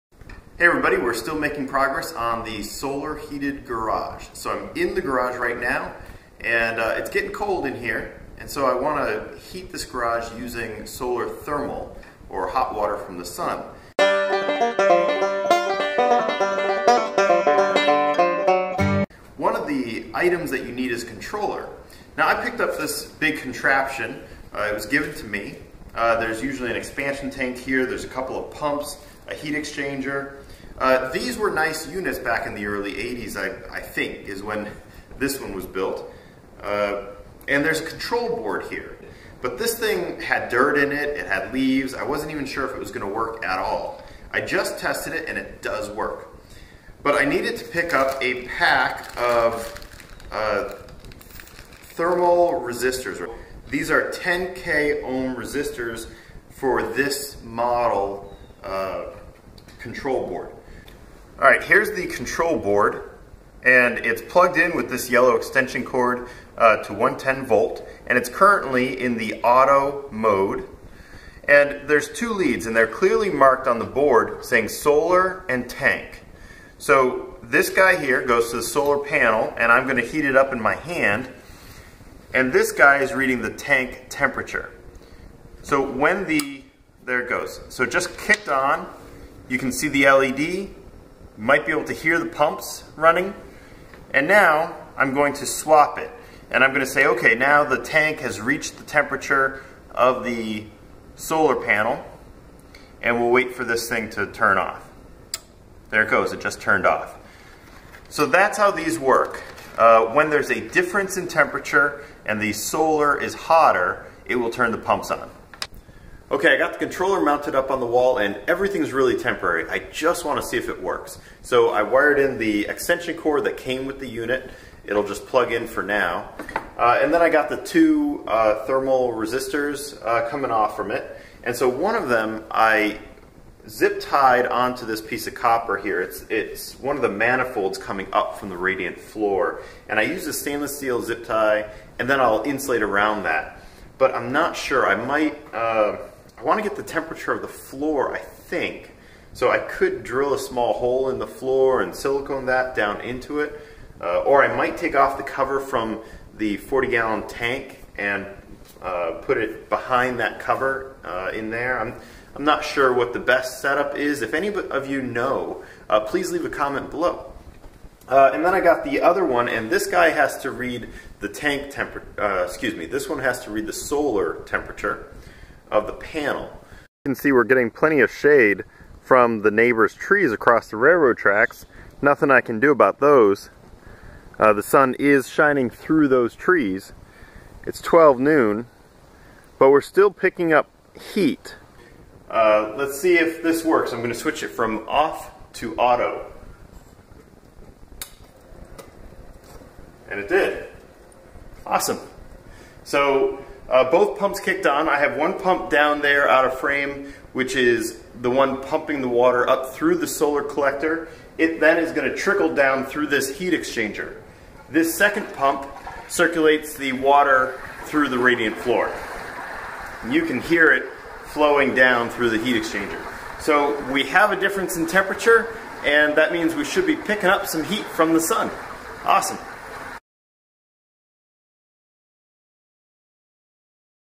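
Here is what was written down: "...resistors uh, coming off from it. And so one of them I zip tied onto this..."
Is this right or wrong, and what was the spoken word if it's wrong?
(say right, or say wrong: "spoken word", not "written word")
right.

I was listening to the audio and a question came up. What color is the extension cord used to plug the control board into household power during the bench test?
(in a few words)
Yellow.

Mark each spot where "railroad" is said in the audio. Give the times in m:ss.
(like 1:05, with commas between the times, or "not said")
3:00.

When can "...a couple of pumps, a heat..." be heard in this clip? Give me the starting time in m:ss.
0:28.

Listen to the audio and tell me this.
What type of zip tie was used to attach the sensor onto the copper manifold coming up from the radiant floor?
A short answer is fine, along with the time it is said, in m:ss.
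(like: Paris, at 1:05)
Stainless steel, at 2:20.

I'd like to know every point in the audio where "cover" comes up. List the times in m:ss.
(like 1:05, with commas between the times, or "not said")
2:35, 2:40.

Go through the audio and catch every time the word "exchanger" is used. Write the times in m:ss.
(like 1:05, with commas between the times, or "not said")
0:29, 3:33, 3:42.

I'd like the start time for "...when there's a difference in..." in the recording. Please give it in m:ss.
1:50.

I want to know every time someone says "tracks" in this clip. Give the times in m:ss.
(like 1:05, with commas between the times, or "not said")
3:01.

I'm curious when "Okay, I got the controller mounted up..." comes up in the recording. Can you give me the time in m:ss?
1:56.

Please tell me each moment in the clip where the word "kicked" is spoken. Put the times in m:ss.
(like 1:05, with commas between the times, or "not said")
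1:28, 3:24.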